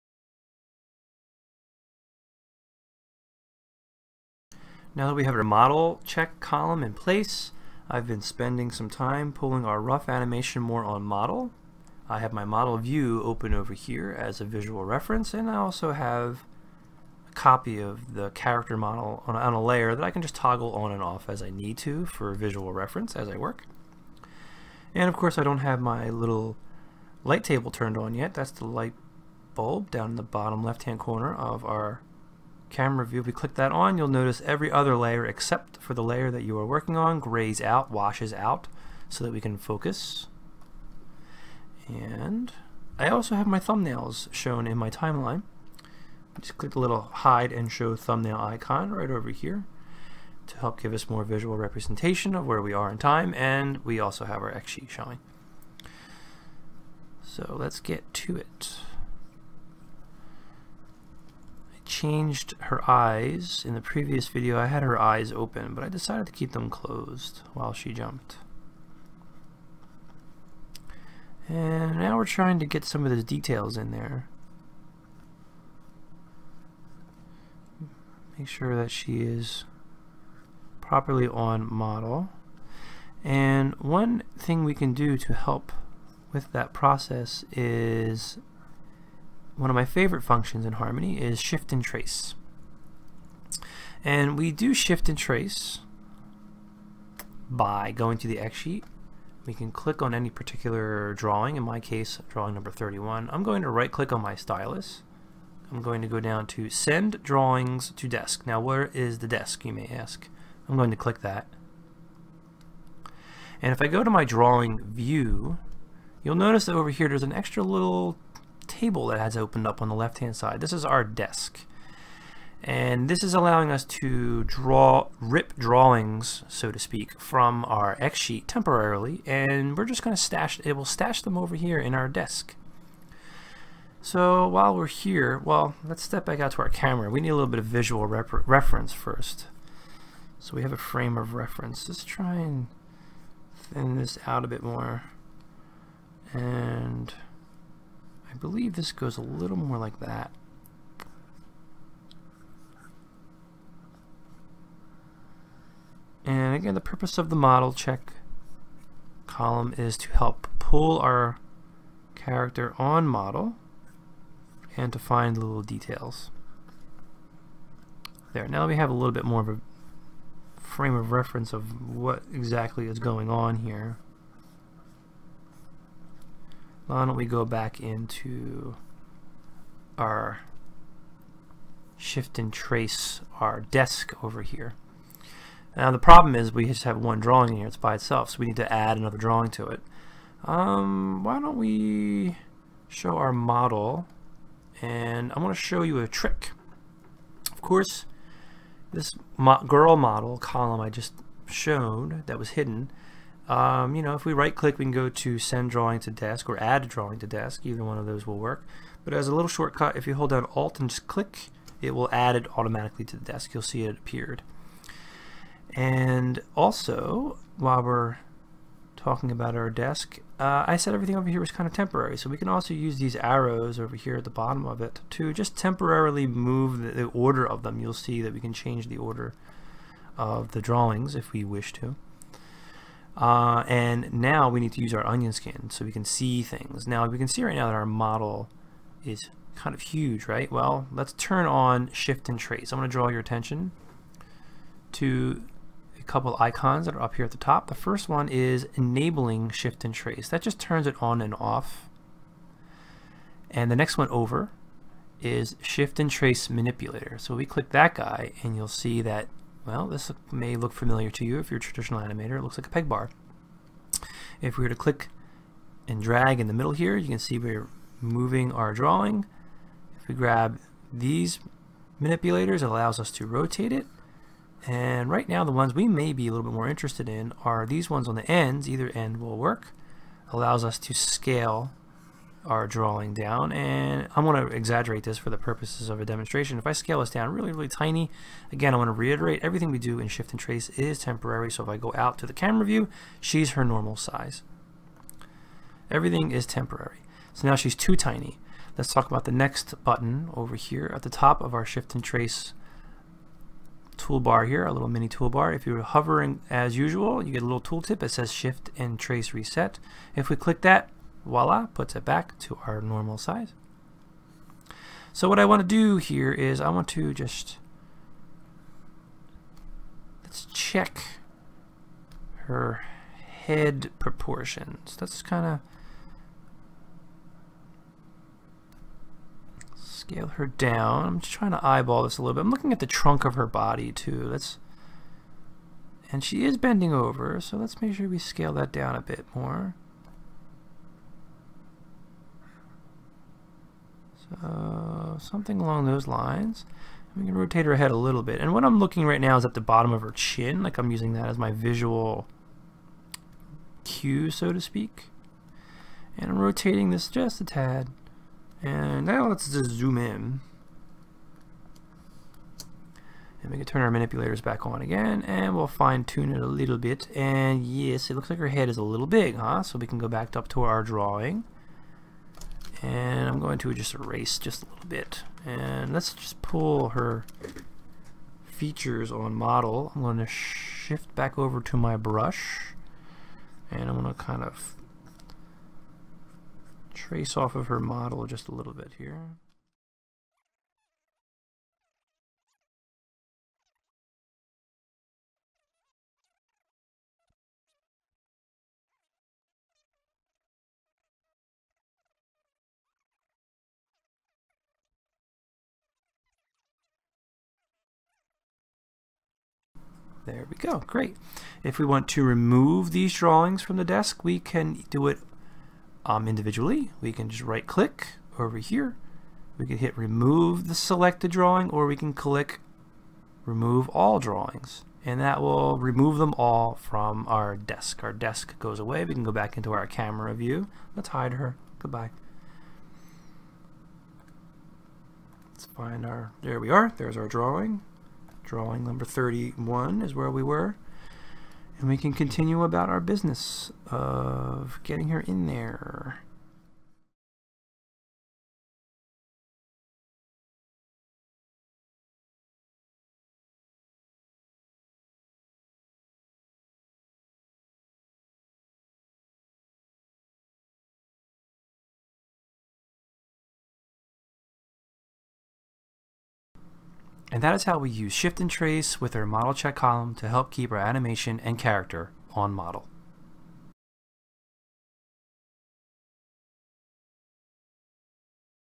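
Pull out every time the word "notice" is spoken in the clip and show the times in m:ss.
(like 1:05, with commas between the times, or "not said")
0:34, 1:56.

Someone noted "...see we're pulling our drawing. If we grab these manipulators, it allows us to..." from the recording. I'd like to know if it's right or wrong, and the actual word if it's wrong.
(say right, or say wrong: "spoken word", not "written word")
wrong: "moving", not "pulling".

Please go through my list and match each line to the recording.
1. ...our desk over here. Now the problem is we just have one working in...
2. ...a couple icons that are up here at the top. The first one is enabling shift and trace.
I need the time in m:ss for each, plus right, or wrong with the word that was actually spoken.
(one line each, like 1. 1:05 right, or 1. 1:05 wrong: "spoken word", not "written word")
1. 3:03 wrong: "drawing", not "working"
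2. 4:05 right.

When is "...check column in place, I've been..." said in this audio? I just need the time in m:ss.
0:06.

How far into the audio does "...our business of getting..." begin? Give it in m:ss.
7:22.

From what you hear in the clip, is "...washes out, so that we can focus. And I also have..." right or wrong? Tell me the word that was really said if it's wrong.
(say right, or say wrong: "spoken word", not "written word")
right.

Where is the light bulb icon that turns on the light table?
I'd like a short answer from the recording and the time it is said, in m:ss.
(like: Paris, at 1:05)
Bottom left hand corner, at 0:30.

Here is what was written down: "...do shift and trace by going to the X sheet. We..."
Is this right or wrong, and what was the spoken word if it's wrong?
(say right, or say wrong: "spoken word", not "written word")
right.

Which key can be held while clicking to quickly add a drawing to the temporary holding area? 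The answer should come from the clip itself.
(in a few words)
Alt.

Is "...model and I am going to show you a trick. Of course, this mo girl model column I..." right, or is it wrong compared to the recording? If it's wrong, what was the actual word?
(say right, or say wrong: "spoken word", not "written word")
right.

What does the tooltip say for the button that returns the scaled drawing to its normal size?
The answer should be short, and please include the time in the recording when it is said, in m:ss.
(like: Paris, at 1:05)
Shift and Trace Reset, at 5:08.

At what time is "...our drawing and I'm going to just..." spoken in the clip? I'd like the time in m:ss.
6:10.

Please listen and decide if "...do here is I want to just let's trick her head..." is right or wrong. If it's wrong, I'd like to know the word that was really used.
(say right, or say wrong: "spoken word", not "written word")
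wrong: "check", not "trick".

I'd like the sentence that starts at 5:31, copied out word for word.
I'm just trying to eyeball this a little bit.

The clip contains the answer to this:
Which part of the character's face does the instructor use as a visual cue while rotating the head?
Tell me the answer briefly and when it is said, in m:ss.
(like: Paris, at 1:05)
Bottom of her chin, at 5:49.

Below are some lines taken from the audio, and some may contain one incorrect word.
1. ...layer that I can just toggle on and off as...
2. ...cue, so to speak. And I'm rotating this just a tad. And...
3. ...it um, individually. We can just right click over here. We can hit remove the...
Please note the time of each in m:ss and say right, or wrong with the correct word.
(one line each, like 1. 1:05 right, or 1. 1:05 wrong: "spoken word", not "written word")
1. 0:19 right
2. 5:53 right
3. 6:55 right.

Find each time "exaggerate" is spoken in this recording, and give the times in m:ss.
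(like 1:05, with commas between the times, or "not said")
4:44.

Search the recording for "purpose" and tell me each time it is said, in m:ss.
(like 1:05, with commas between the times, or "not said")
2:36, 4:45.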